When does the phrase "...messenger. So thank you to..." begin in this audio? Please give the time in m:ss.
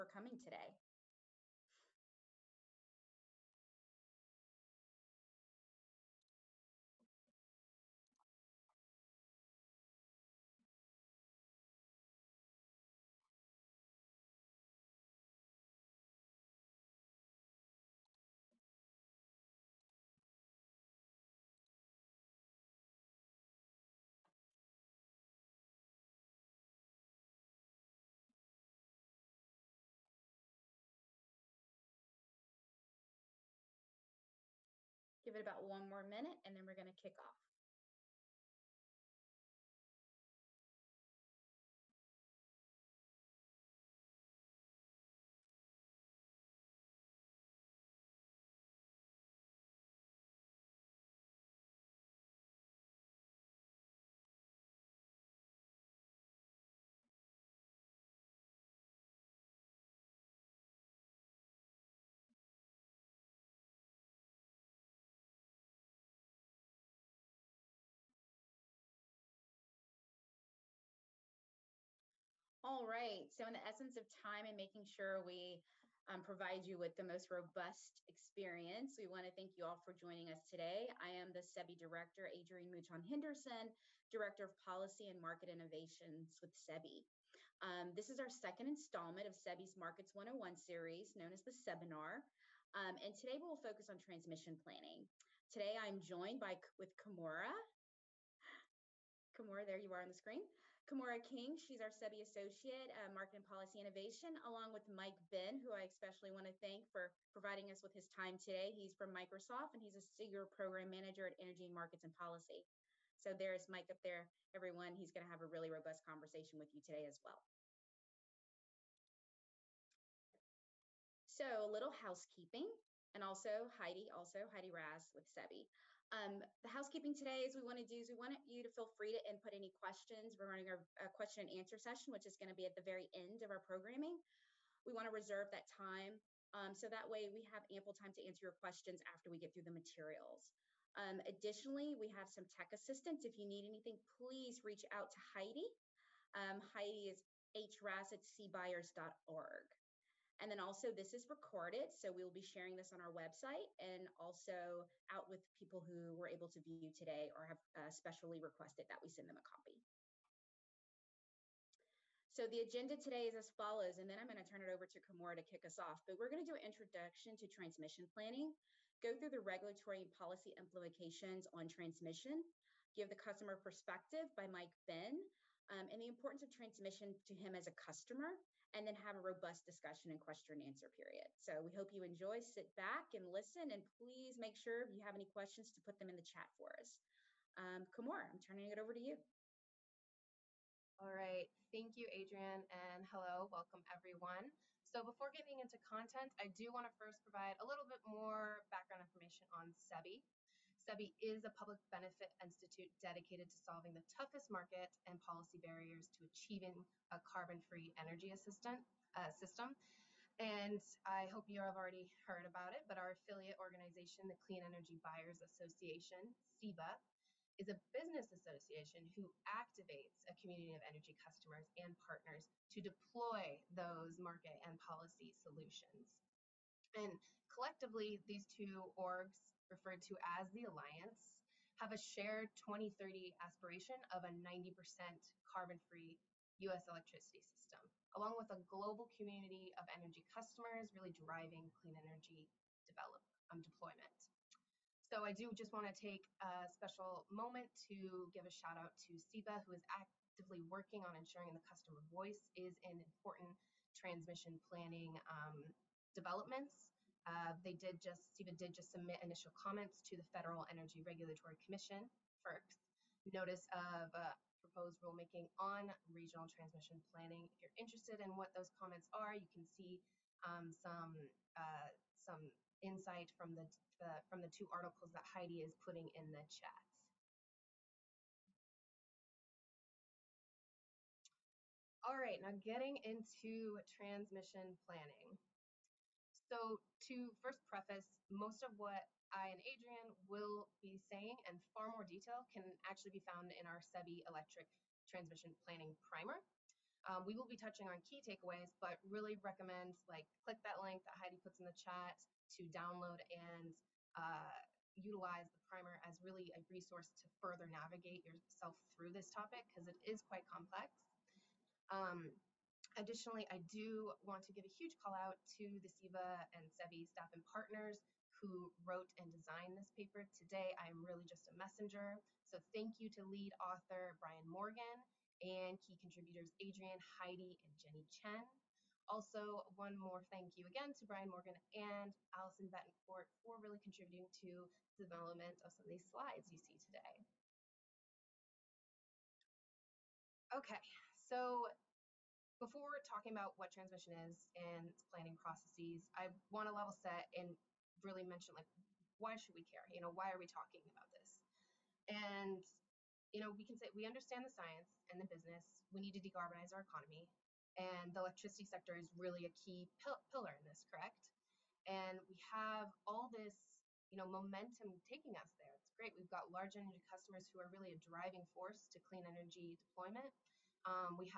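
5:21.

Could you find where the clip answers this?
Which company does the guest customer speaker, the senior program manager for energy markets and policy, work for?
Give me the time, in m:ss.
1:49.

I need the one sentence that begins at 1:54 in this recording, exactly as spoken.
He's going to have a really robust conversation with you today as well.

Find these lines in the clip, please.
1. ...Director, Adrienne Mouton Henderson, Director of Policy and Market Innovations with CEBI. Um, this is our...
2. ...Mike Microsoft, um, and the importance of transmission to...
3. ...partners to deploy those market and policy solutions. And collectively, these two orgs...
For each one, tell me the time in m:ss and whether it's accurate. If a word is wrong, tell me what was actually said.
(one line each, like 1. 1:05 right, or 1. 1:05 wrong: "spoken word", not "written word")
1. 1:21 right
2. 2:54 wrong: "Ben", not "Microsoft"
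3. 3:41 right.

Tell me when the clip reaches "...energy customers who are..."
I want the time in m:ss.
6:06.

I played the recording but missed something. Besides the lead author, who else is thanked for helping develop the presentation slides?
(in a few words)
Allison Betancourt.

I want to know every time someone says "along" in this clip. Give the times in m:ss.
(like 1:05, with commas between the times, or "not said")
1:44, 3:58.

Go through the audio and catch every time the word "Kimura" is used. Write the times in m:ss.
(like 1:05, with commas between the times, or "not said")
1:36, 2:45.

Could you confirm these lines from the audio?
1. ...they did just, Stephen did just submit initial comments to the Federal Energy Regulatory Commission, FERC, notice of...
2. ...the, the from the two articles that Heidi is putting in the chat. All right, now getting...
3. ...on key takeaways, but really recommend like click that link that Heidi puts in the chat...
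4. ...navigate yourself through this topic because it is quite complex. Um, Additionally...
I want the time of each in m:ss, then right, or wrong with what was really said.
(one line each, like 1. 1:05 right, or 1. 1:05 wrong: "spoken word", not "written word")
1. 4:17 right
2. 4:33 right
3. 4:57 right
4. 5:07 right.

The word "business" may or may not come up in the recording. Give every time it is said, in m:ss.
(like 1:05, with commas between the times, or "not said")
3:37, 5:55.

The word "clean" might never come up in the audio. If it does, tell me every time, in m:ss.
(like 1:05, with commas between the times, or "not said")
3:34, 4:01, 6:08.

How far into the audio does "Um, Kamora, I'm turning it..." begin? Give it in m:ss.
3:07.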